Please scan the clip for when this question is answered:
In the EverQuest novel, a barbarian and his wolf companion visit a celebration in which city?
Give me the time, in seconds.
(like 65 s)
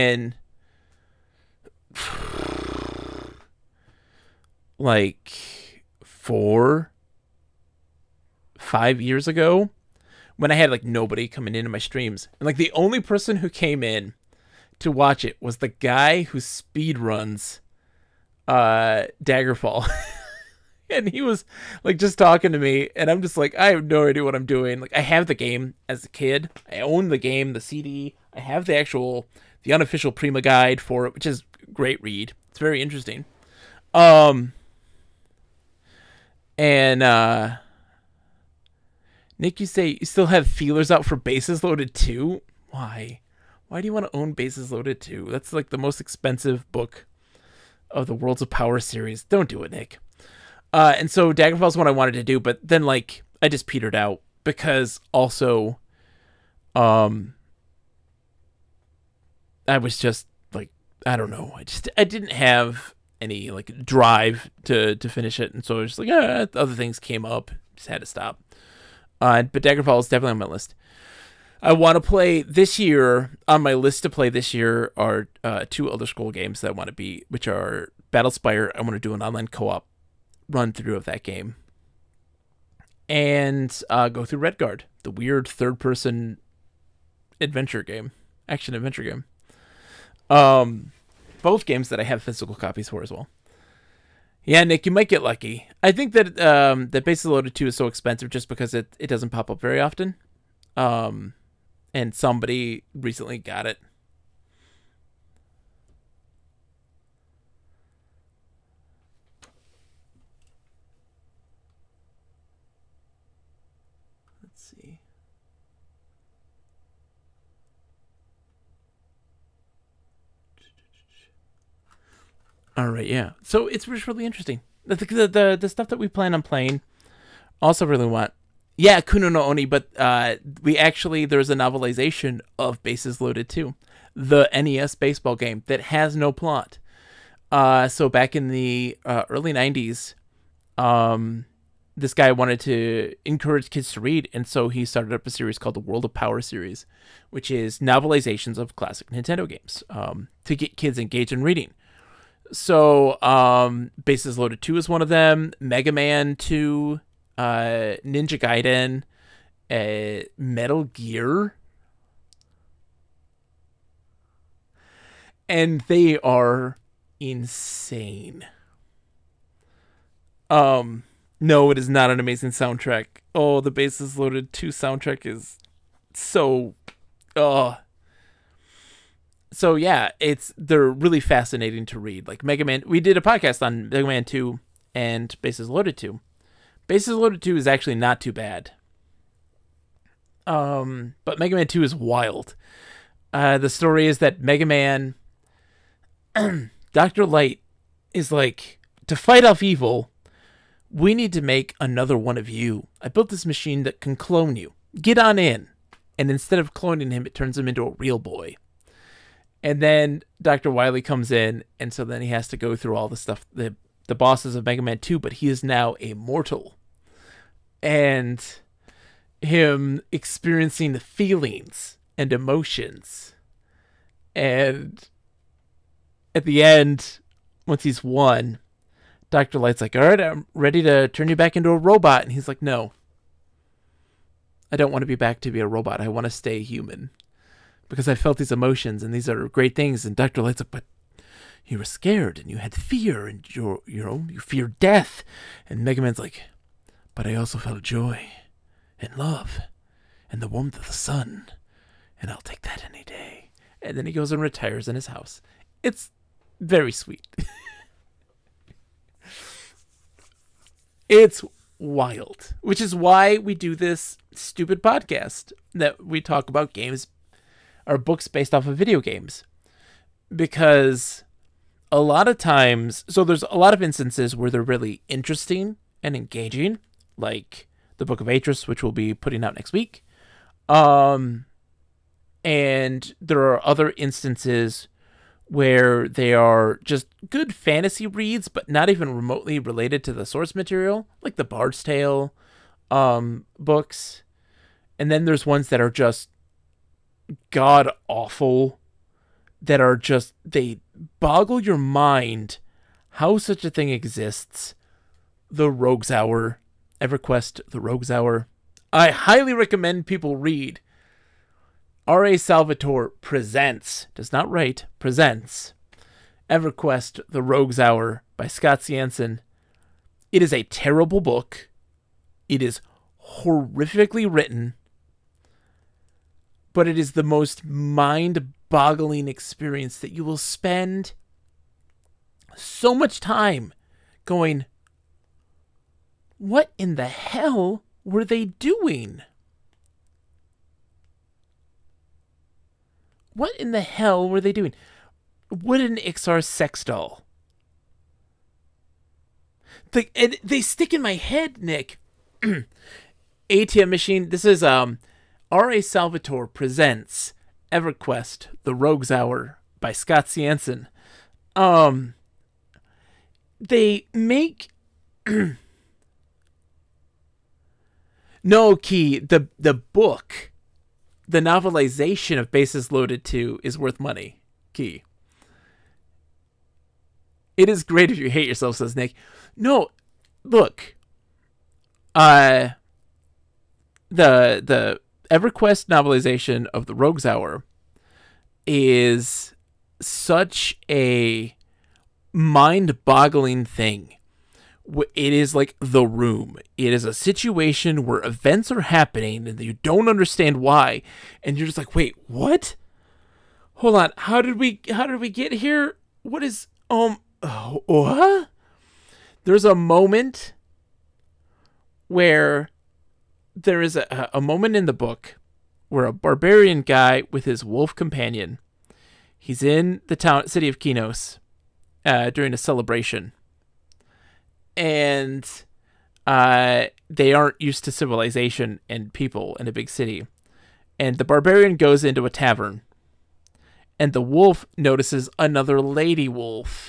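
420 s.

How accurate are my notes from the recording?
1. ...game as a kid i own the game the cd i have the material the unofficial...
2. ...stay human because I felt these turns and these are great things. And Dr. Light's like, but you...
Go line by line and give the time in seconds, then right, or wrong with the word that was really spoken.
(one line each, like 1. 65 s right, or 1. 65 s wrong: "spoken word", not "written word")
1. 25 s wrong: "actual", not "material"
2. 236 s wrong: "emotions", not "turns".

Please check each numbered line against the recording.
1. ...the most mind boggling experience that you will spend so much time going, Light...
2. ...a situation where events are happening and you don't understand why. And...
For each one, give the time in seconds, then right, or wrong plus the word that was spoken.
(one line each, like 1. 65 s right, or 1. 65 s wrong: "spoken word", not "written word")
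1. 327 s wrong: "What", not "Light"
2. 397 s right.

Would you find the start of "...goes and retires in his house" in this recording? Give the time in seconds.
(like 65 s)
254 s.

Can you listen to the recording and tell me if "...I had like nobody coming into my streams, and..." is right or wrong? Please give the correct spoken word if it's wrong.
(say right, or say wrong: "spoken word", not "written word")
right.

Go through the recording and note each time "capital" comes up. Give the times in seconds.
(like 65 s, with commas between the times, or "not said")
not said.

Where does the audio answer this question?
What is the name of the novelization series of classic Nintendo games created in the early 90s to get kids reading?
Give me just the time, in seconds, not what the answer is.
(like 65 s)
145 s.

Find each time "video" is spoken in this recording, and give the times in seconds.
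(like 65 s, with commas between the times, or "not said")
268 s.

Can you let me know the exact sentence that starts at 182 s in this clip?
Like Mega Man, we did a podcast on Mega Man Two and Bases Loaded Two.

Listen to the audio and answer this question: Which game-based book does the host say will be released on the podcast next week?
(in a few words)
Book of Atrus.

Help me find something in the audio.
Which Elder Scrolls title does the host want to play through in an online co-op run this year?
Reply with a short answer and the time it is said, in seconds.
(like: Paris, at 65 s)
Battlespire, at 78 s.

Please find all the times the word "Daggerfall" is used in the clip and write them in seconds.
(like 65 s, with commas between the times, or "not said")
19 s, 51 s, 69 s.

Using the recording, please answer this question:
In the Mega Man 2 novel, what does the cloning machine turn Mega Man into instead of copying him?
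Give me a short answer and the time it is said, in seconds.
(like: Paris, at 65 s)
a real boy, at 207 s.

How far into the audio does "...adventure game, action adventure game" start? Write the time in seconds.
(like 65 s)
87 s.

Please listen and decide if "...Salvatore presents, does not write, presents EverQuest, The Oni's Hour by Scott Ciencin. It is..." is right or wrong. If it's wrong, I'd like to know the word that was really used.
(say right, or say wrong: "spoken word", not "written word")
wrong: "Rogue", not "Oni".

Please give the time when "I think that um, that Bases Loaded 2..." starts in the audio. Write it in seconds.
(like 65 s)
95 s.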